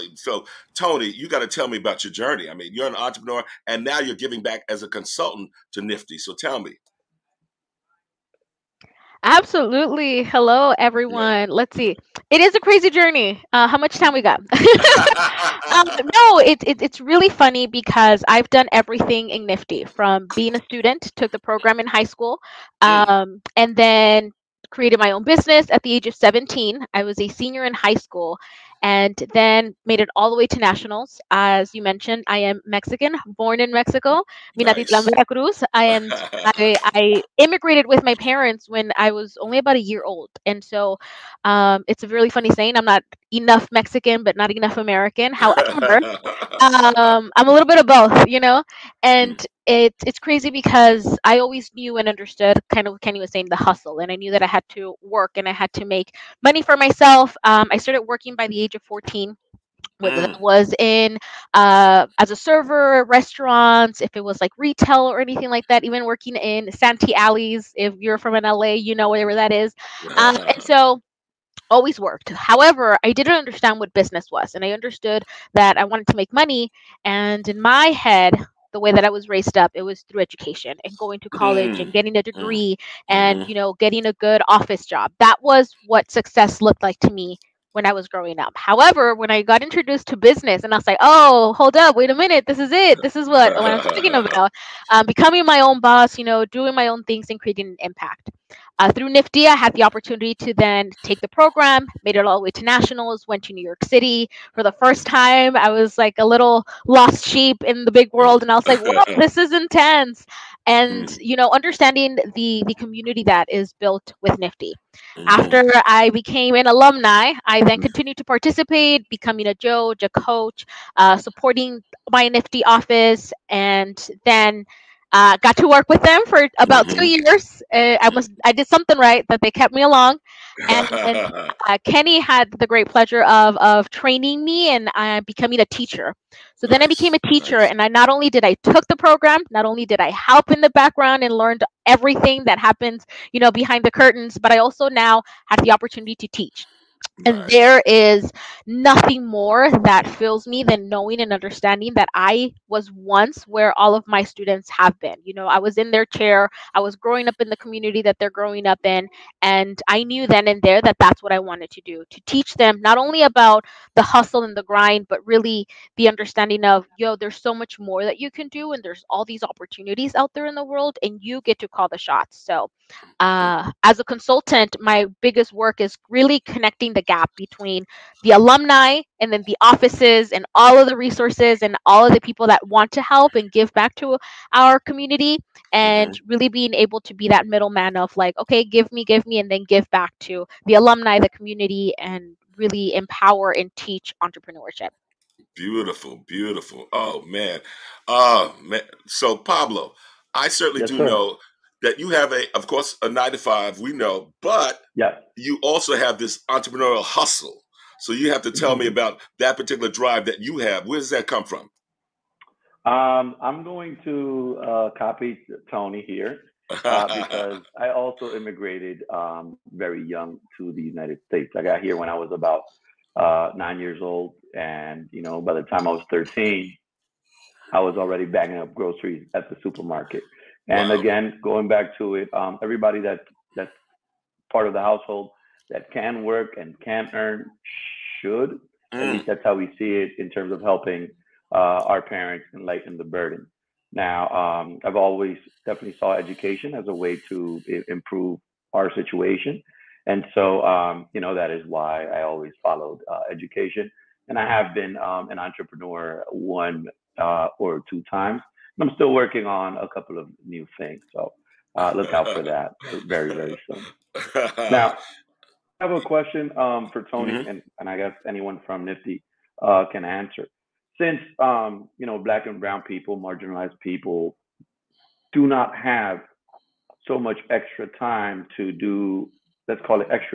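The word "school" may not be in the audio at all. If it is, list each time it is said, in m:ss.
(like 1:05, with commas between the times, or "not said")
0:22, 0:27.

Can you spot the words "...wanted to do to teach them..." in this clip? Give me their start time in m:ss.
2:41.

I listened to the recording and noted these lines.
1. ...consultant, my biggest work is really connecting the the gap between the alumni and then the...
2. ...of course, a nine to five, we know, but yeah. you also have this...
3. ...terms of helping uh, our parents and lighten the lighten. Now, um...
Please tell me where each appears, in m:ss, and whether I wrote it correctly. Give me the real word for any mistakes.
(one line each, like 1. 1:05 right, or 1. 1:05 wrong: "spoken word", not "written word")
1. 2:54 right
2. 3:22 right
3. 4:00 wrong: "burden", not "lighten".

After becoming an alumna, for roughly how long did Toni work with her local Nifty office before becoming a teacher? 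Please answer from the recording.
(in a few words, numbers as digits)
2 years.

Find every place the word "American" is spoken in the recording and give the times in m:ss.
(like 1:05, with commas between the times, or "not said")
0:44.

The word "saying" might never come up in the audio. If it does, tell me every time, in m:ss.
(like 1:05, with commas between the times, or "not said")
0:42, 0:53.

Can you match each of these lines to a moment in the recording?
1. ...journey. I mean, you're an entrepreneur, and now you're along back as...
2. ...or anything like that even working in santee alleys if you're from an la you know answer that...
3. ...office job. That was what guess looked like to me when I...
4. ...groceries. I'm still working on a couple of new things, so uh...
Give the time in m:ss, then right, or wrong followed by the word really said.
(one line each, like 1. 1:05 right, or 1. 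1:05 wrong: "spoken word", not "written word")
1. 0:02 wrong: "giving", not "along"
2. 1:05 wrong: "wherever", not "answer"
3. 1:24 wrong: "success", not "guess"
4. 4:18 wrong: "times", not "groceries".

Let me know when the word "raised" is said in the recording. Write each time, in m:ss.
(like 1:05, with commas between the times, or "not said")
1:19.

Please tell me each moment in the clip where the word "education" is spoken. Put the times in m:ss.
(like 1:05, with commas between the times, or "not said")
1:20, 4:06, 4:13.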